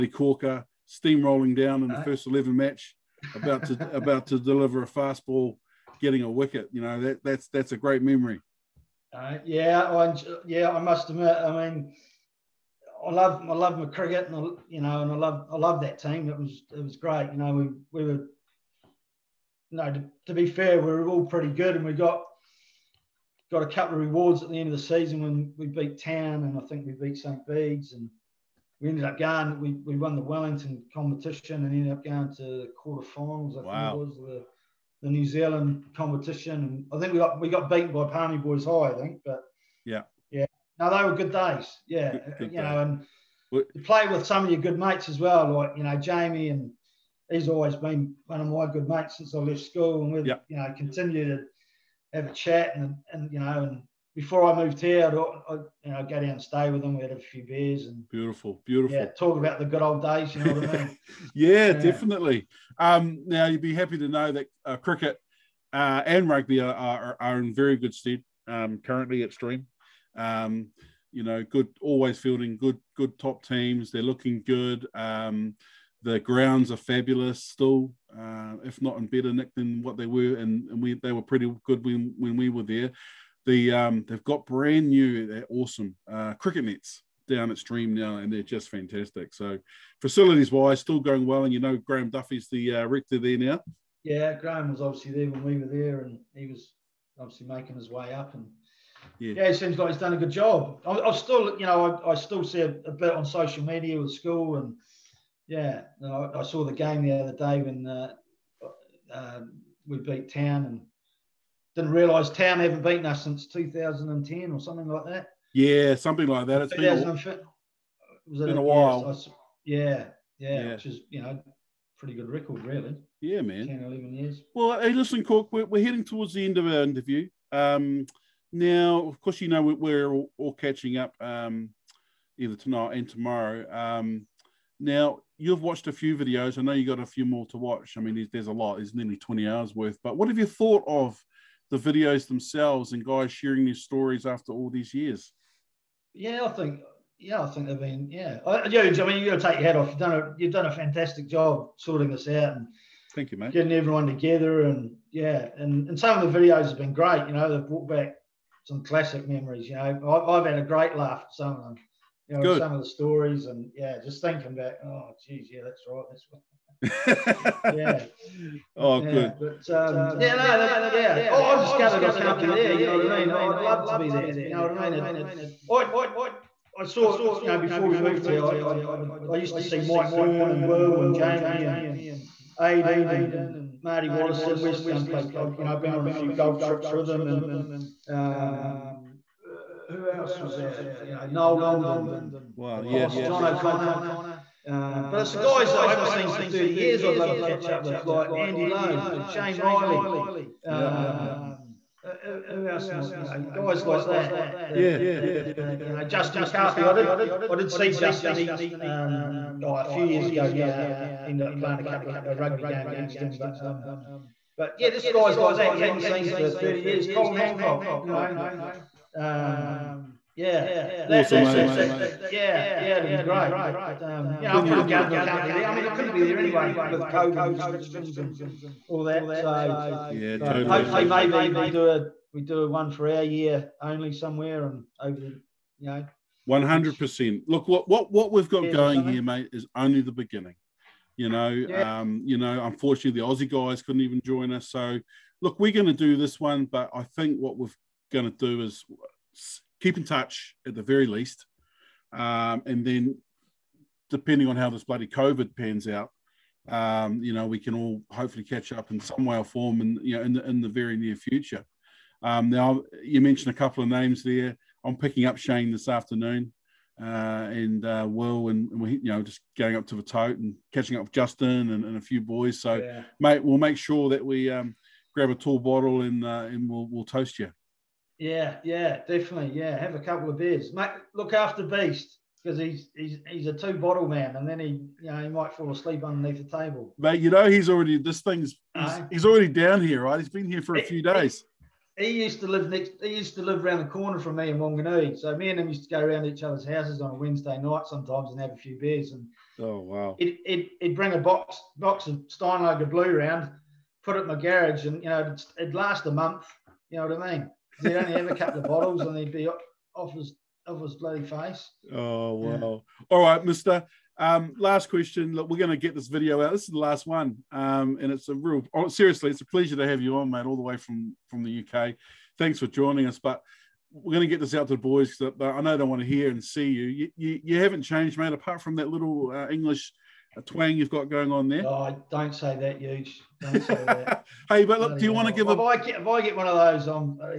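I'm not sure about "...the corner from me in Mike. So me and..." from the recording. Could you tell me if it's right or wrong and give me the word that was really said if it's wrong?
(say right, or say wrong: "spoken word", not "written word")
wrong: "Wanganui", not "Mike".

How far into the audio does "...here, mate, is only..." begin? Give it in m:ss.
3:59.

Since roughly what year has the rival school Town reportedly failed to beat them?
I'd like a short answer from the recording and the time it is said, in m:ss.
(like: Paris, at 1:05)
2010, at 1:53.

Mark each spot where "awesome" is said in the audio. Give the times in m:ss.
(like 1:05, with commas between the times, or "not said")
1:25, 3:41.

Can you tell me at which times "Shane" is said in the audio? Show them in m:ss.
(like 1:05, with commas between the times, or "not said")
3:19, 4:25.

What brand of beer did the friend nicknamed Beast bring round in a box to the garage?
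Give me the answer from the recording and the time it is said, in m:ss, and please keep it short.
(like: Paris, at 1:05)
Steinlager Blue, at 5:02.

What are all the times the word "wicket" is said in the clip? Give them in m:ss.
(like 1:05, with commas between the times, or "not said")
0:06.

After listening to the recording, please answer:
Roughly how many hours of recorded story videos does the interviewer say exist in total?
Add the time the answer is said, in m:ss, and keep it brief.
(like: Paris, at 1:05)
20 hours, at 2:19.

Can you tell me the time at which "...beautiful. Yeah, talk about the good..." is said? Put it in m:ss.
0:58.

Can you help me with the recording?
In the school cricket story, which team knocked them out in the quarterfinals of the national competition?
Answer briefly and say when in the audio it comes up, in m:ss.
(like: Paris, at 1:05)
Palmy Boys High, at 0:38.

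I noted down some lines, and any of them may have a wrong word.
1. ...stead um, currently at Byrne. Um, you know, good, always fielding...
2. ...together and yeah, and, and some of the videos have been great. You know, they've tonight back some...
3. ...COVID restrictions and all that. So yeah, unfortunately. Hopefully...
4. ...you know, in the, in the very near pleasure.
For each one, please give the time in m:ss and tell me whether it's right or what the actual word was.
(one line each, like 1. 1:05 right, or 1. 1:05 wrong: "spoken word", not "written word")
1. 1:07 wrong: "Stream", not "Byrne"
2. 2:34 wrong: "brought", not "tonight"
3. 3:47 wrong: "totally", not "unfortunately"
4. 4:20 wrong: "future", not "pleasure".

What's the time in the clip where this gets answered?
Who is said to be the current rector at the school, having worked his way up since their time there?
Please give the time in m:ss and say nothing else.
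1:31.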